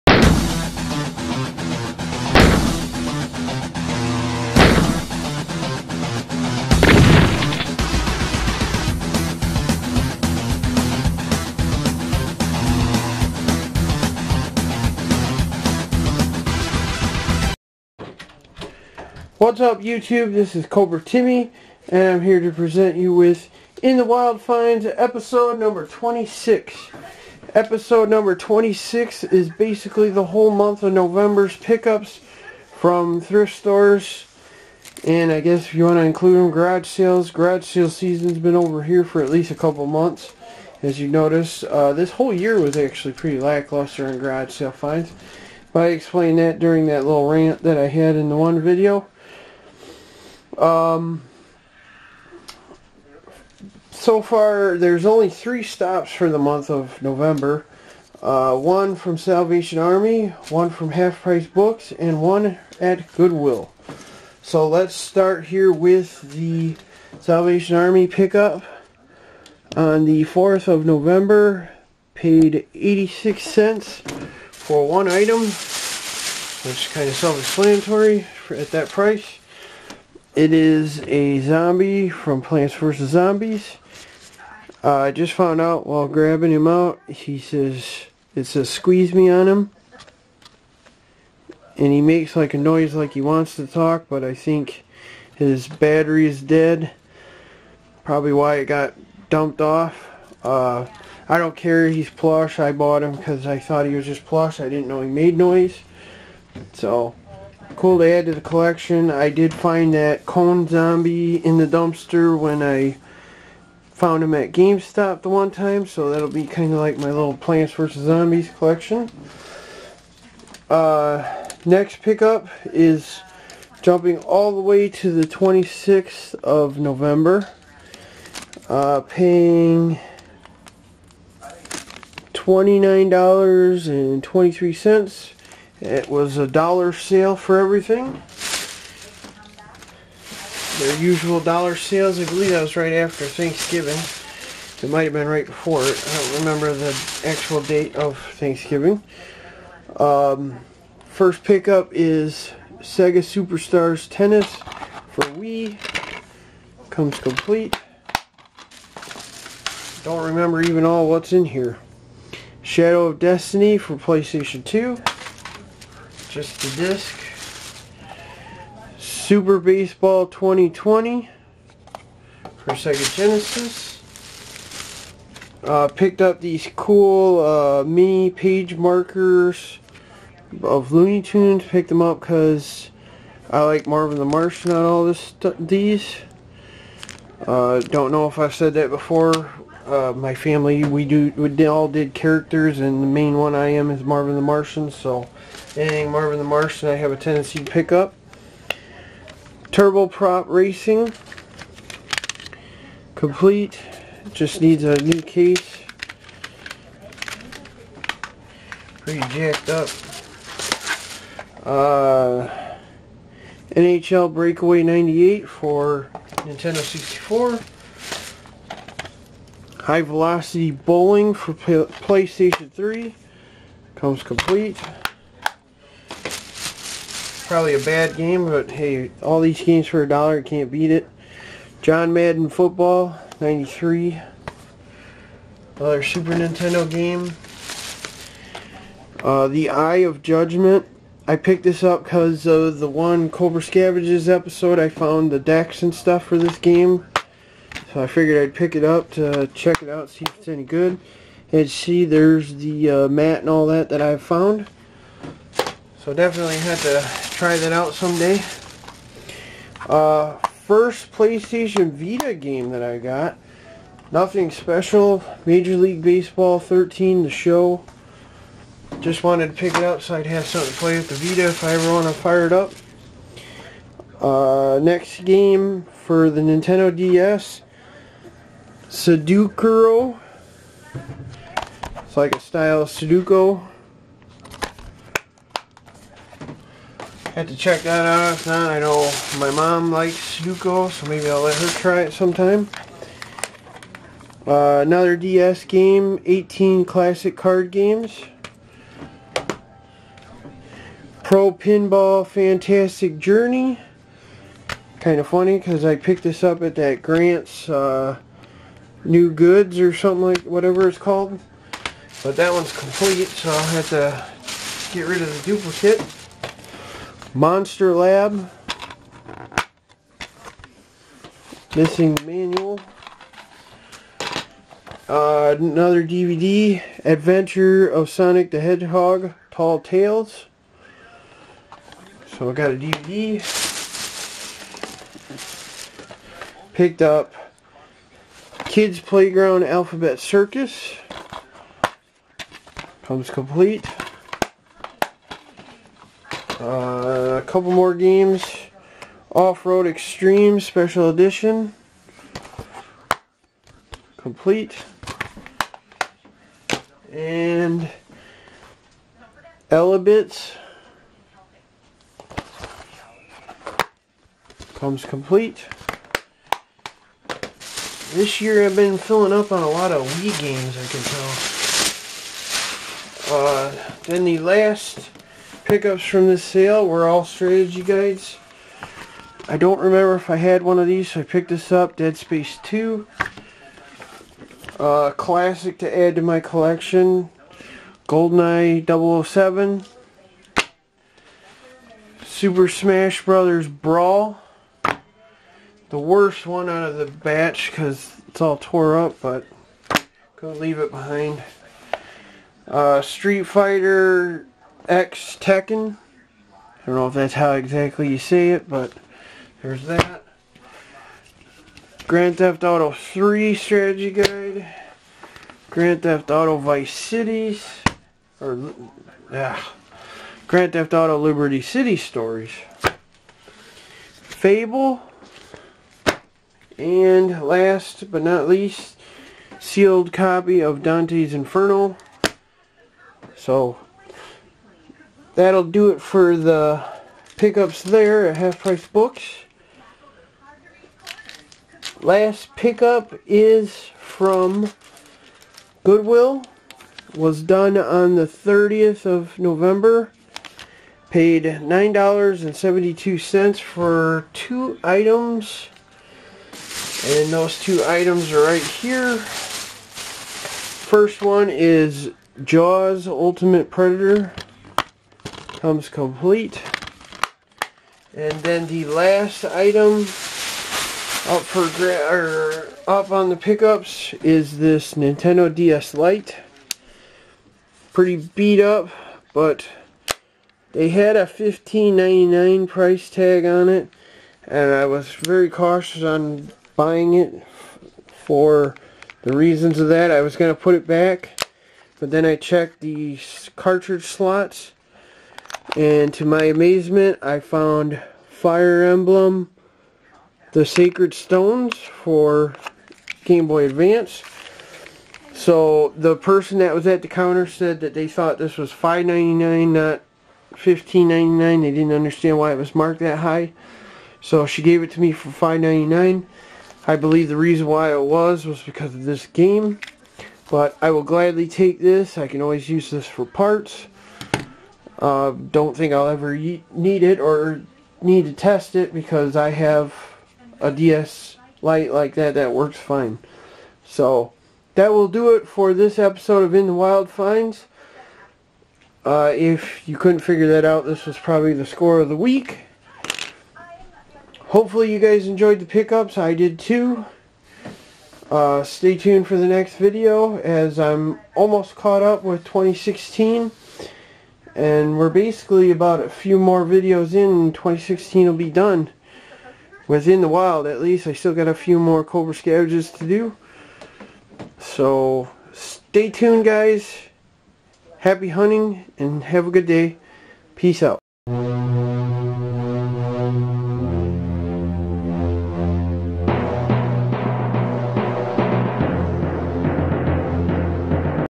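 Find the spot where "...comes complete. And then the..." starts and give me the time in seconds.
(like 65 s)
465 s.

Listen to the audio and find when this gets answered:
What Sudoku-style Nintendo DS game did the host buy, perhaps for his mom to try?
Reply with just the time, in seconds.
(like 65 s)
278 s.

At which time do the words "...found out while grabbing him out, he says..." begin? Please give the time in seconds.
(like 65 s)
85 s.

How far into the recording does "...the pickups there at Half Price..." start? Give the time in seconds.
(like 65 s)
436 s.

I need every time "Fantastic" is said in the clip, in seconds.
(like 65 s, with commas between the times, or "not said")
302 s.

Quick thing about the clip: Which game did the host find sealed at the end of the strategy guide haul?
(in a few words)
Dante's Inferno.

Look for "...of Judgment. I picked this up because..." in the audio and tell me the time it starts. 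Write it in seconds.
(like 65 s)
239 s.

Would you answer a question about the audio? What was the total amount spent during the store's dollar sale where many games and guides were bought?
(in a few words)
$29.23.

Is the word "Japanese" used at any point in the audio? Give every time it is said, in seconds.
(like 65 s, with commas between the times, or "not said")
not said.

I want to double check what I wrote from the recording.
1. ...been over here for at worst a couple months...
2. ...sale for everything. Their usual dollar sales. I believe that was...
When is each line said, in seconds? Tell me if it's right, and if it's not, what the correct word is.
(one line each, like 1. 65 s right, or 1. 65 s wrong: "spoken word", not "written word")
1. 38 s wrong: "least", not "worst"
2. 136 s right.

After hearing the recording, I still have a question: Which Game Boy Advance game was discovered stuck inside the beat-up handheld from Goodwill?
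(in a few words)
Fire Emblem, The Sacred Stones.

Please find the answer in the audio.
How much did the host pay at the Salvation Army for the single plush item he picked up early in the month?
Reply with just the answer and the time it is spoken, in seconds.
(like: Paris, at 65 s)
86 cents, at 72 s.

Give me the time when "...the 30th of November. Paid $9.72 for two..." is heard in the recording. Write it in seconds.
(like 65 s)
448 s.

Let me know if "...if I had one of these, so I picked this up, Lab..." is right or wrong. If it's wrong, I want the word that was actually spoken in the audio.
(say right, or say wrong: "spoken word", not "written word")
wrong: "Dead", not "Lab".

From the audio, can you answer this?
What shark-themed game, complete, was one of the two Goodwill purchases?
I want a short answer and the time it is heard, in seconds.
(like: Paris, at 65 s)
Jaws Ultimate Predator, at 462 s.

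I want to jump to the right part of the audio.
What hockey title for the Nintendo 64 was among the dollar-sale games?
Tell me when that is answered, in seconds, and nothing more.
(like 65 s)
213 s.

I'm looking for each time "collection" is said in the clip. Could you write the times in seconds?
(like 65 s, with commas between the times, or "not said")
108 s, 118 s, 386 s.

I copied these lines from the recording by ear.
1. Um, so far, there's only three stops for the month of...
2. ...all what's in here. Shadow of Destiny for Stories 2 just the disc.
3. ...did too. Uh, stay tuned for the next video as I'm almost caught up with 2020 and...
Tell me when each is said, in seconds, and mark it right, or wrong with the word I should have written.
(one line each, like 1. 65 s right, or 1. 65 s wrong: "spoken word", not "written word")
1. 50 s right
2. 160 s wrong: "PlayStation", not "Stories"
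3. 546 s wrong: "2016", not "2020".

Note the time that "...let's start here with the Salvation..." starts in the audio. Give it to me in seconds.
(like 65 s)
64 s.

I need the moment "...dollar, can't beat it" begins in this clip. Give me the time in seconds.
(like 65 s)
230 s.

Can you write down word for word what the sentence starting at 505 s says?
So the person that was at the counter said that they thought this was $5.99, not $15.99.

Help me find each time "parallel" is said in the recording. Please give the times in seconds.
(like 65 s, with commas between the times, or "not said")
not said.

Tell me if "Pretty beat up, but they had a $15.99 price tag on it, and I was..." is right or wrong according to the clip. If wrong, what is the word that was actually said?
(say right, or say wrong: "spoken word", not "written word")
right.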